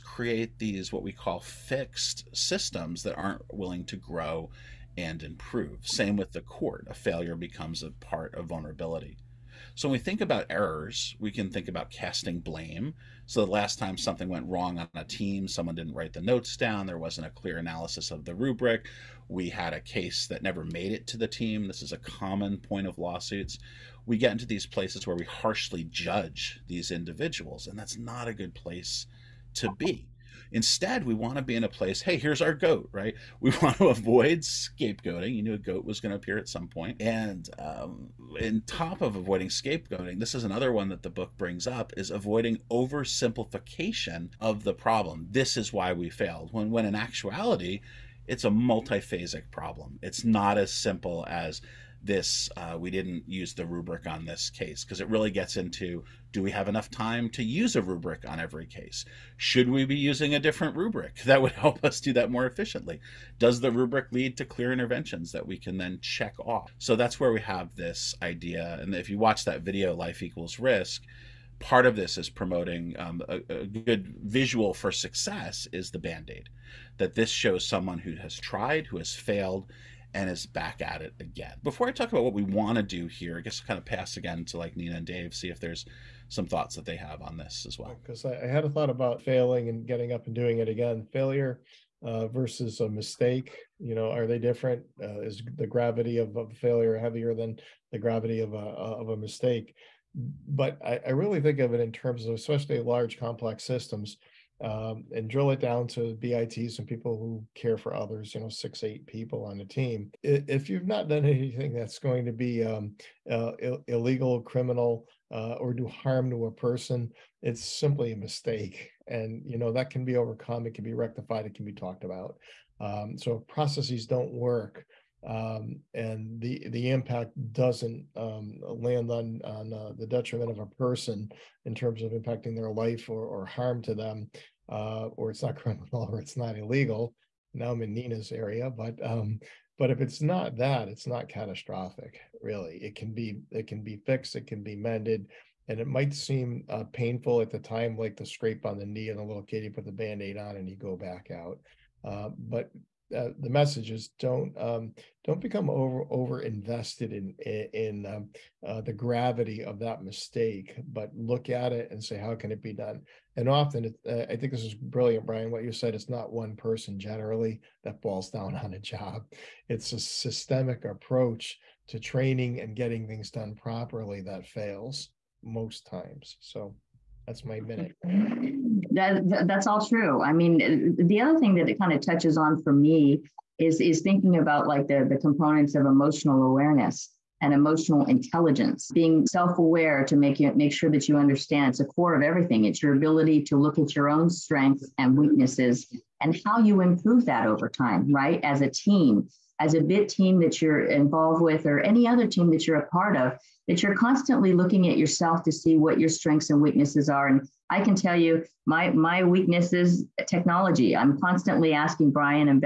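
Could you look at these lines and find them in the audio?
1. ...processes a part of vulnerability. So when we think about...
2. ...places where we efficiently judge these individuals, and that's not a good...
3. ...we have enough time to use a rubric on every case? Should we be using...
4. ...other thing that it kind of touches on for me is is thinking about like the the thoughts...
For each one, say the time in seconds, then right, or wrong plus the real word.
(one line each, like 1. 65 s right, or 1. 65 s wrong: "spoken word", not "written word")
1. 7 s wrong: "becomes", not "processes"
2. 24 s wrong: "harshly", not "efficiently"
3. 56 s right
4. 181 s wrong: "components", not "thoughts".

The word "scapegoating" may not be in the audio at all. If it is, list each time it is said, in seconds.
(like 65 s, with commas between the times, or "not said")
34 s, 39 s.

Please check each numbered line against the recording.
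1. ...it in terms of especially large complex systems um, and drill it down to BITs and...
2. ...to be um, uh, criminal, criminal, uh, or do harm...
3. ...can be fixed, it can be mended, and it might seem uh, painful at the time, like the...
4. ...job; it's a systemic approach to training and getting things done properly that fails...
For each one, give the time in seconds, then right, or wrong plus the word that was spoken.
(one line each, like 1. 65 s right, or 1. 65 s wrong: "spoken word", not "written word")
1. 101 s right
2. 112 s wrong: "illegal", not "criminal"
3. 143 s right
4. 168 s right.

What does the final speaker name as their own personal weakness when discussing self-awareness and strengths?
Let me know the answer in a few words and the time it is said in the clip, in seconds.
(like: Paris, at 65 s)
technology, at 210 s.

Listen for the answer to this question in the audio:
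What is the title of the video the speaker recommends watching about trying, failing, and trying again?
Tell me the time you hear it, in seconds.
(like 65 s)
69 s.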